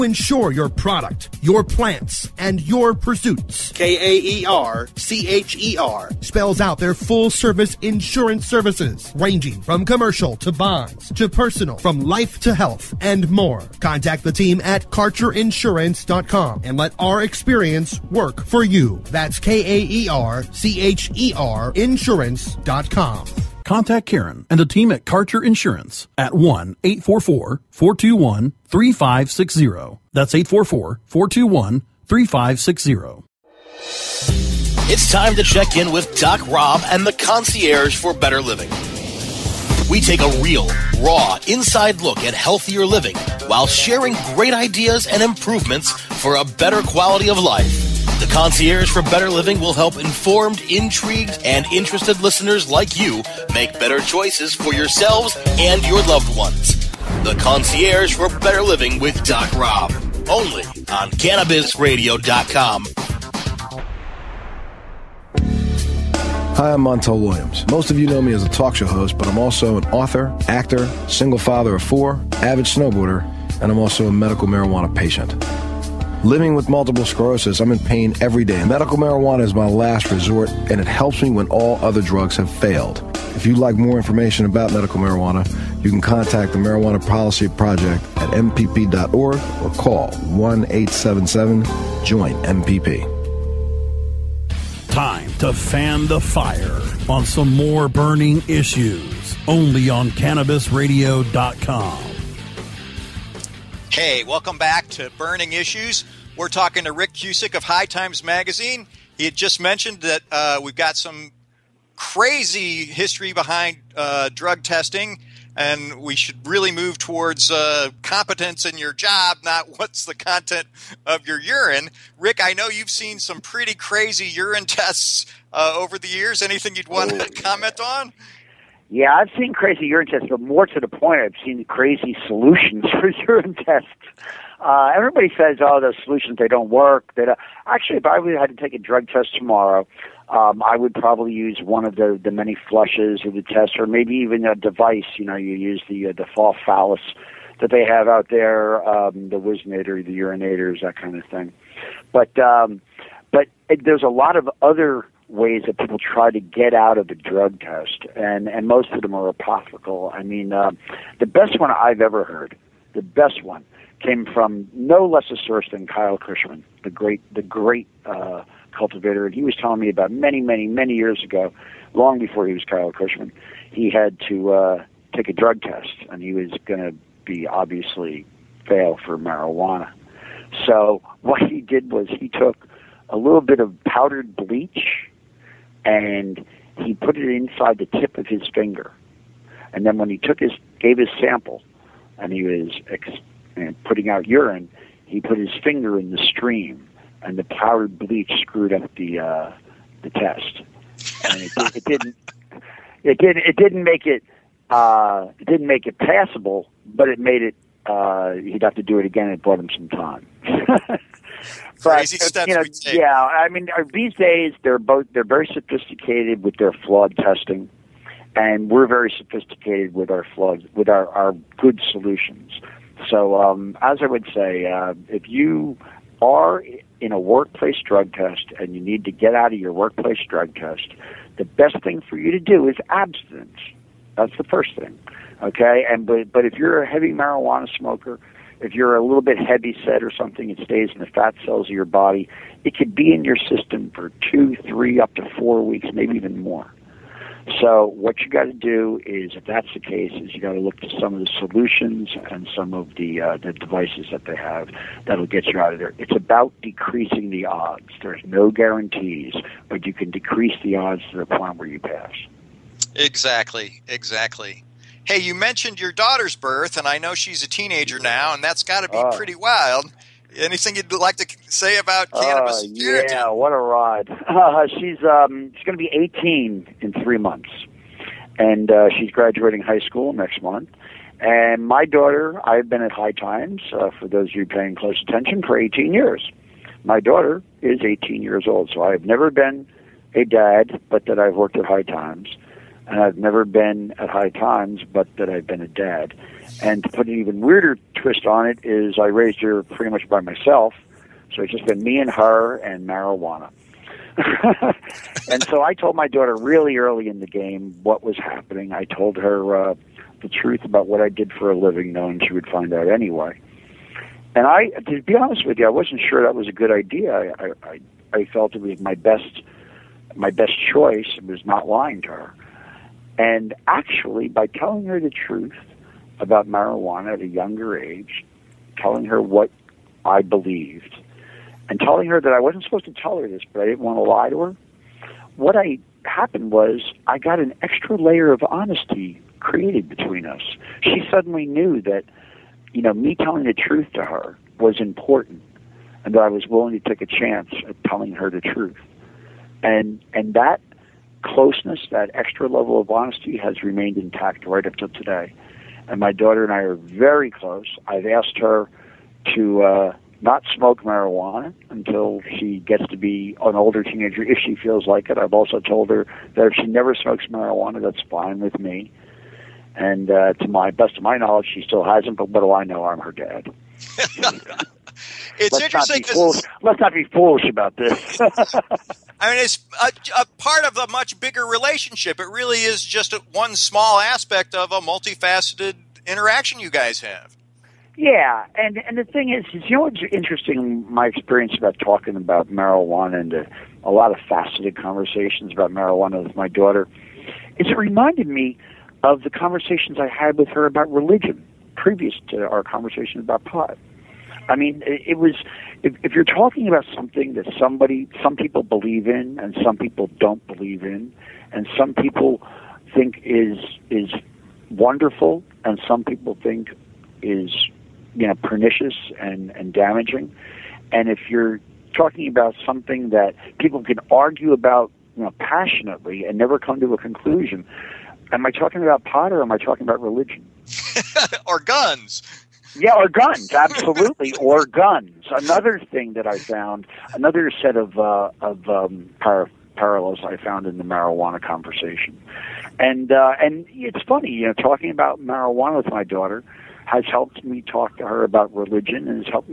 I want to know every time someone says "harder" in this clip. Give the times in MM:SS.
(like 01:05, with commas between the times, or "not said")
not said.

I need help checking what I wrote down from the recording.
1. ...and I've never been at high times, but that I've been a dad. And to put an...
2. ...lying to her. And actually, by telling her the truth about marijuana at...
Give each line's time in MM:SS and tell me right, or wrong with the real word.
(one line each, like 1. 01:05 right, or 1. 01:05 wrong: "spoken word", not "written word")
1. 04:52 right
2. 05:21 right.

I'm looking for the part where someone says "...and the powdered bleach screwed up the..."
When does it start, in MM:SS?
03:17.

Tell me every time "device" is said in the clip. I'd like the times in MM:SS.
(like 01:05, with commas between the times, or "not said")
02:24, 04:13.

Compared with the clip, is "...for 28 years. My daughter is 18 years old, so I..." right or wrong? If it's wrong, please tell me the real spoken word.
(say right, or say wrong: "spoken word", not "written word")
wrong: "18", not "28".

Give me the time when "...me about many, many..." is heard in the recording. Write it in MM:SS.
02:49.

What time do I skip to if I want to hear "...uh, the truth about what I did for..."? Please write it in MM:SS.
05:09.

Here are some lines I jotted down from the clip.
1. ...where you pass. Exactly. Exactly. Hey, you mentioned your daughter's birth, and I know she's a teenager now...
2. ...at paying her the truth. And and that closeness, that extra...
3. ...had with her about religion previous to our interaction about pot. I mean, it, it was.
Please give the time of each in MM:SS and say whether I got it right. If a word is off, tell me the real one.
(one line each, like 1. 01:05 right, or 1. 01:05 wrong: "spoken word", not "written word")
1. 04:21 right
2. 05:47 wrong: "telling", not "paying"
3. 06:40 wrong: "conversation", not "interaction".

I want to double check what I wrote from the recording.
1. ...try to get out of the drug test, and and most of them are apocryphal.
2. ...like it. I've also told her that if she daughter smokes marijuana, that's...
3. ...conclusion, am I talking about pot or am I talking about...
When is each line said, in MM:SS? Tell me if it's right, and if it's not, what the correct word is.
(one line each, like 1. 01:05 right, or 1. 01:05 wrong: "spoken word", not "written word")
1. 02:35 right
2. 06:04 wrong: "never", not "daughter"
3. 07:06 right.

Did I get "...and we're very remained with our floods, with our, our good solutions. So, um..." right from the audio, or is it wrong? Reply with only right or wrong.
wrong.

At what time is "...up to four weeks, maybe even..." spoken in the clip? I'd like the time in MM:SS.
04:04.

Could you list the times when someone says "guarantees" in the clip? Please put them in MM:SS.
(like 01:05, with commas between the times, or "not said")
04:18.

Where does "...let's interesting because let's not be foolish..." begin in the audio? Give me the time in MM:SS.
06:15.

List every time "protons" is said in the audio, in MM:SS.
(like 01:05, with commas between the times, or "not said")
not said.